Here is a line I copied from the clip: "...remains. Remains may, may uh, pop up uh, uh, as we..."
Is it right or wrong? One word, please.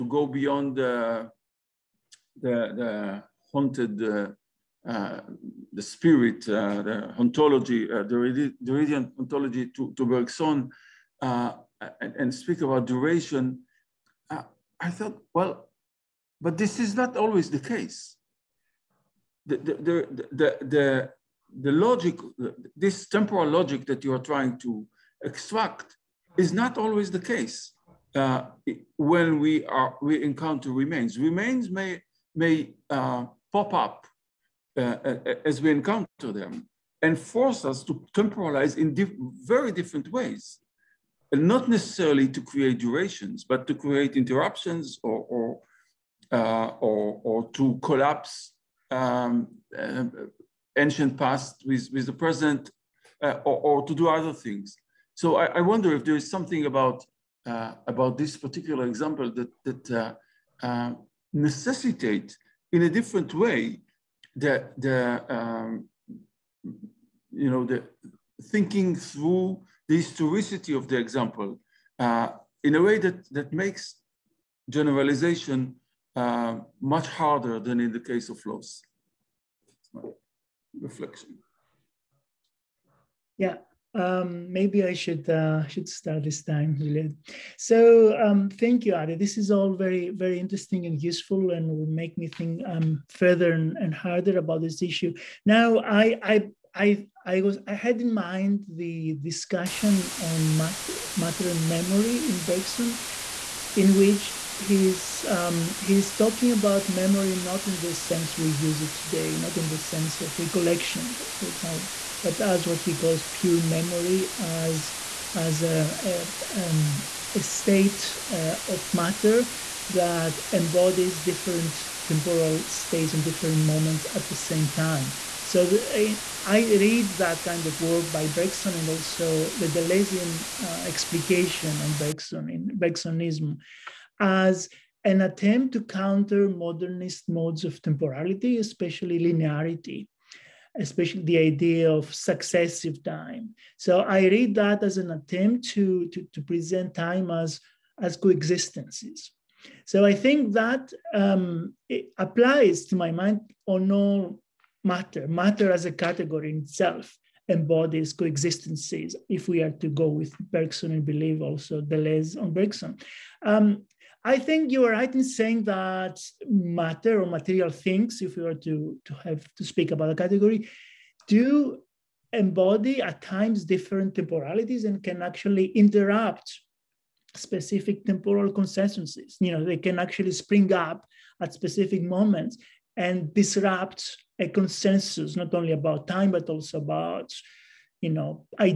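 right.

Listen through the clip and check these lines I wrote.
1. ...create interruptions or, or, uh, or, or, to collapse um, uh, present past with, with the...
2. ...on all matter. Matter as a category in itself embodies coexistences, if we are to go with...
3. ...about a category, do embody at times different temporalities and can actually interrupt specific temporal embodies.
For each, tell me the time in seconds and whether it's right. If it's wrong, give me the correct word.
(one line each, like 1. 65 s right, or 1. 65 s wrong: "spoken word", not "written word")
1. 43 s wrong: "ancient", not "present"
2. 153 s right
3. 169 s wrong: "consensuses", not "embodies".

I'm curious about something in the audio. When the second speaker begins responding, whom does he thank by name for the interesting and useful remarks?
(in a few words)
Adi.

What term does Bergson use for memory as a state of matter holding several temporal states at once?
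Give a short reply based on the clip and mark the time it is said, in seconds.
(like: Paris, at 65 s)
pure memory, at 113 s.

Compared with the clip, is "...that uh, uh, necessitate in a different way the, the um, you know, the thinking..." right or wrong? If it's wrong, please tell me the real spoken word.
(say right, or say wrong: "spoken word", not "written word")
right.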